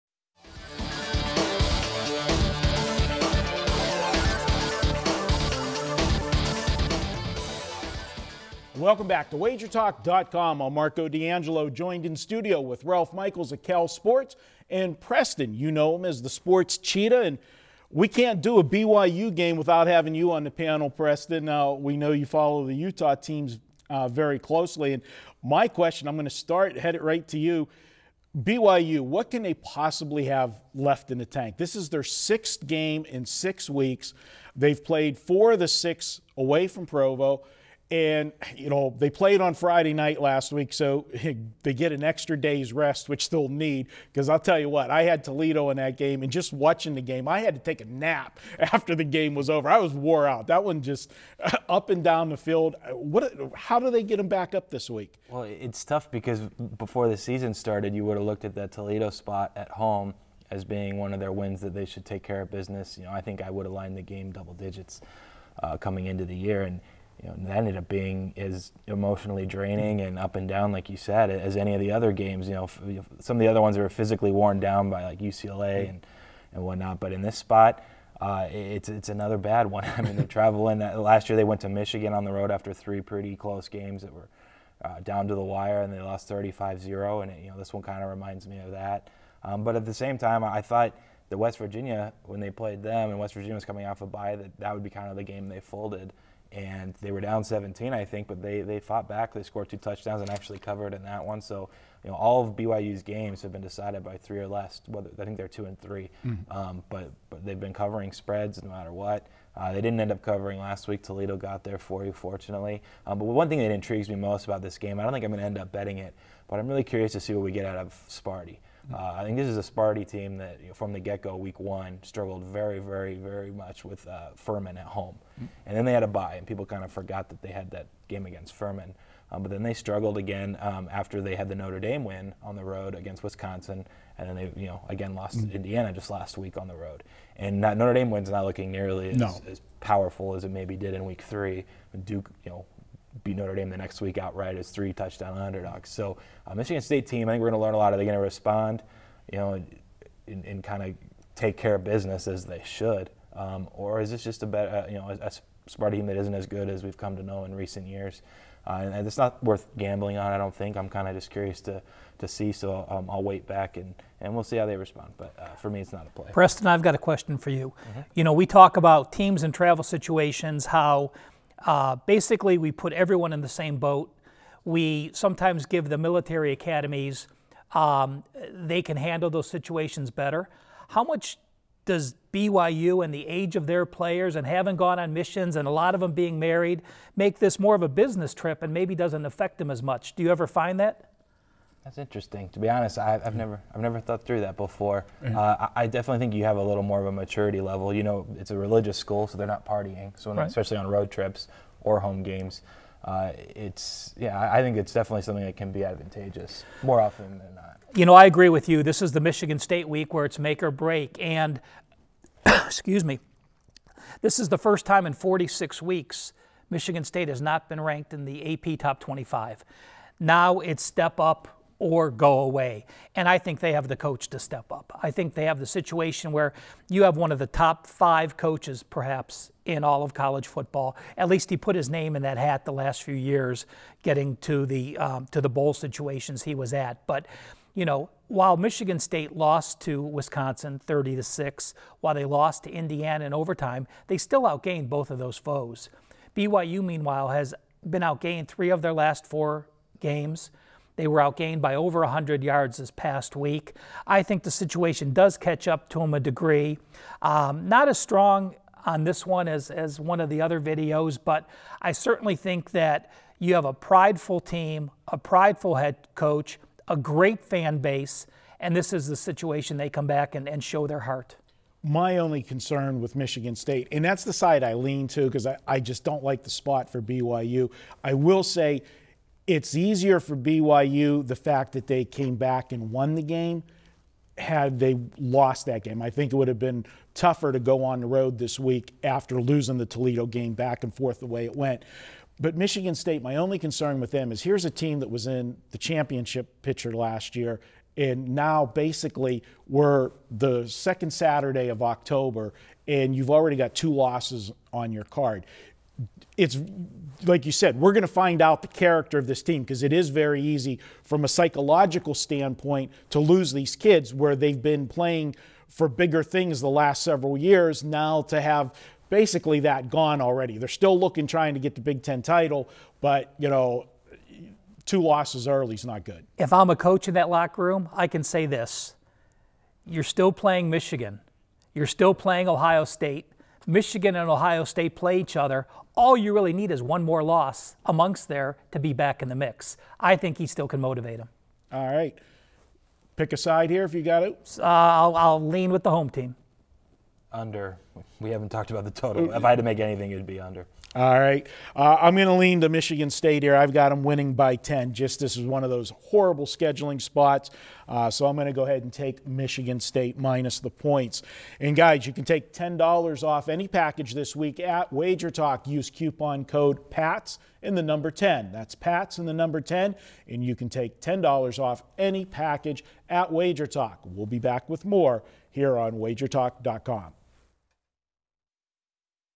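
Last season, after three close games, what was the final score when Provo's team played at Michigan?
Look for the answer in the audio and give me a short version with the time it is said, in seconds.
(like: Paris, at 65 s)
35-0, at 86 s.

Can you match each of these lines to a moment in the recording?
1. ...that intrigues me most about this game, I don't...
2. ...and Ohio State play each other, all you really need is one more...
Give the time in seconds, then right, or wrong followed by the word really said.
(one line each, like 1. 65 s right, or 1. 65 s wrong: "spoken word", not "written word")
1. 113 s right
2. 334 s right.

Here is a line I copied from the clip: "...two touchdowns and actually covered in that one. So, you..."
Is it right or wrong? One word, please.
right.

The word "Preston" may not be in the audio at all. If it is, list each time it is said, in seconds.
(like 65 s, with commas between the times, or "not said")
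14 s, 20 s, 166 s.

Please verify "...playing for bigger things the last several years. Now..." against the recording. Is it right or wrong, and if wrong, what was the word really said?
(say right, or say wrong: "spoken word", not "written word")
right.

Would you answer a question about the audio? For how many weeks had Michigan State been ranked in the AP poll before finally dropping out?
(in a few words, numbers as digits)
46.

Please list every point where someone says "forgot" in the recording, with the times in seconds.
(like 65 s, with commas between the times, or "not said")
126 s.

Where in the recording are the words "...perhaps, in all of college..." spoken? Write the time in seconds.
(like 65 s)
228 s.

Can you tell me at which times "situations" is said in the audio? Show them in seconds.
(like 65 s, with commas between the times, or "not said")
169 s, 179 s, 225 s, 235 s, 254 s, 269 s.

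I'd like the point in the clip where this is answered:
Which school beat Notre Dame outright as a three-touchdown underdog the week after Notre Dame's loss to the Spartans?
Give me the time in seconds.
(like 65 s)
142 s.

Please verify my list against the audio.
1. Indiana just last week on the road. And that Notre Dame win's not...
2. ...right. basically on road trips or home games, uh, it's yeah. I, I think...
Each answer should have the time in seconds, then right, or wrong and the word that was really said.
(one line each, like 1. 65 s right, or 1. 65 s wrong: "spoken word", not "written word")
1. 135 s right
2. 200 s wrong: "especially", not "basically".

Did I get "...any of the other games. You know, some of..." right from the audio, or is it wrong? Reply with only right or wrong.
right.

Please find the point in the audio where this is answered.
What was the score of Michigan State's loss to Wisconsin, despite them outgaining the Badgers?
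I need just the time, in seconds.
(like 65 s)
240 s.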